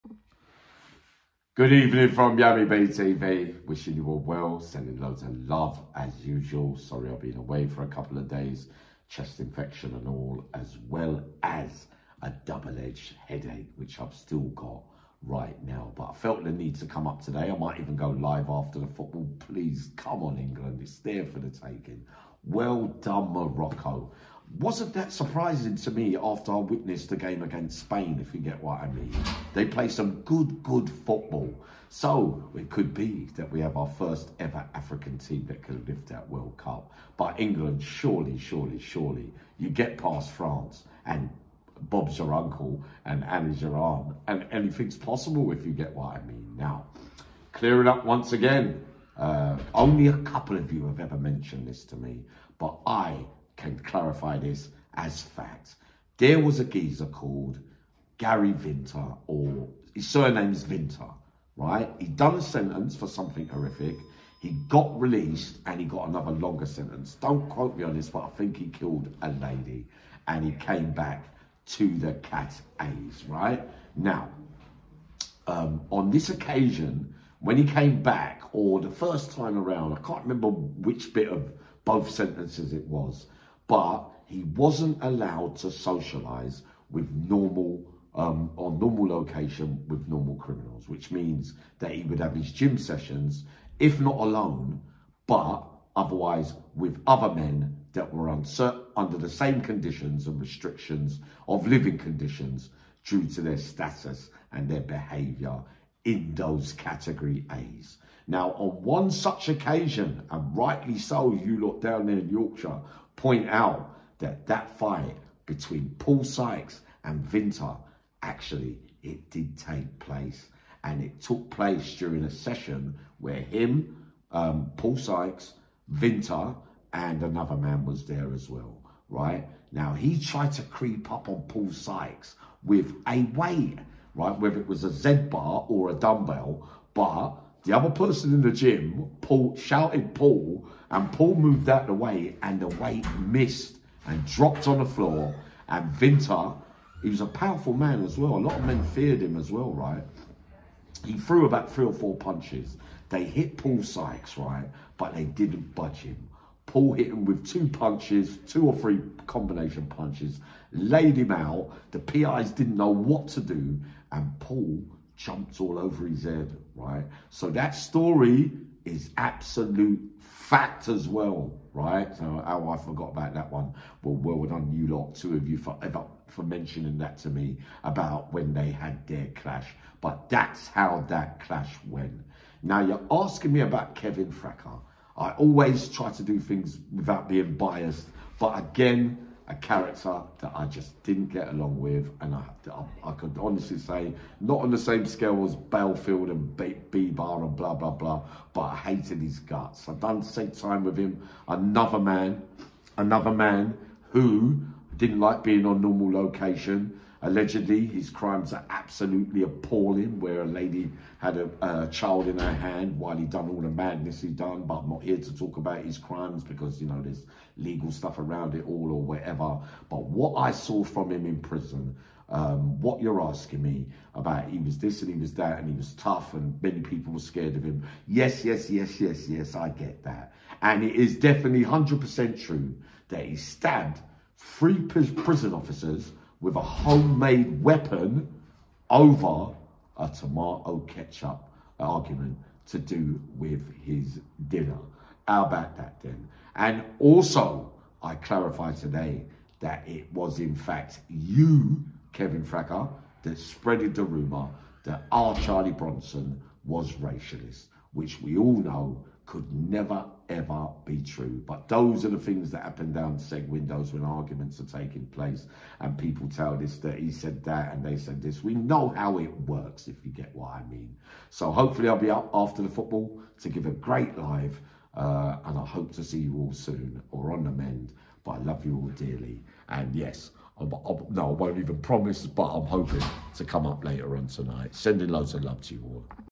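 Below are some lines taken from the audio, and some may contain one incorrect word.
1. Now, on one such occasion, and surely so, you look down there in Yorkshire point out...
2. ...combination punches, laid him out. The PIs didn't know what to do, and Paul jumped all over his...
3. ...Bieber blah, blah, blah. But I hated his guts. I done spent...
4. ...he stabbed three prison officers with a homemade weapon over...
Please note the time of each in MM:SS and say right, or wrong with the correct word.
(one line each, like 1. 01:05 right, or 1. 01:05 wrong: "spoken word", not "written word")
1. 01:48 wrong: "rightly", not "surely"
2. 02:39 right
3. 03:16 right
4. 03:53 right.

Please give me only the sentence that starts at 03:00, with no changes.
But that's how that clash went.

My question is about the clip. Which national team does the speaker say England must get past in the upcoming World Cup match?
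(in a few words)
France.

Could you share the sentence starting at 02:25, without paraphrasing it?
And Vinter, he was a powerful man as well.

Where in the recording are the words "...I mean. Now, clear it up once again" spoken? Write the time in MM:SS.
00:46.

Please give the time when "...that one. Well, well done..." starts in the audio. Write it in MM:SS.
02:53.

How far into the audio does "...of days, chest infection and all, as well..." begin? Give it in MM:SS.
00:08.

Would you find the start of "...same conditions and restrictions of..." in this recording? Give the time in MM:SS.
01:39.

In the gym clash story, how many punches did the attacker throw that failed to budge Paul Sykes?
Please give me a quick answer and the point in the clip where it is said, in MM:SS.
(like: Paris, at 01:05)
3 or 4, at 02:31.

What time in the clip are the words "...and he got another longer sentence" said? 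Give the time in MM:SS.
01:05.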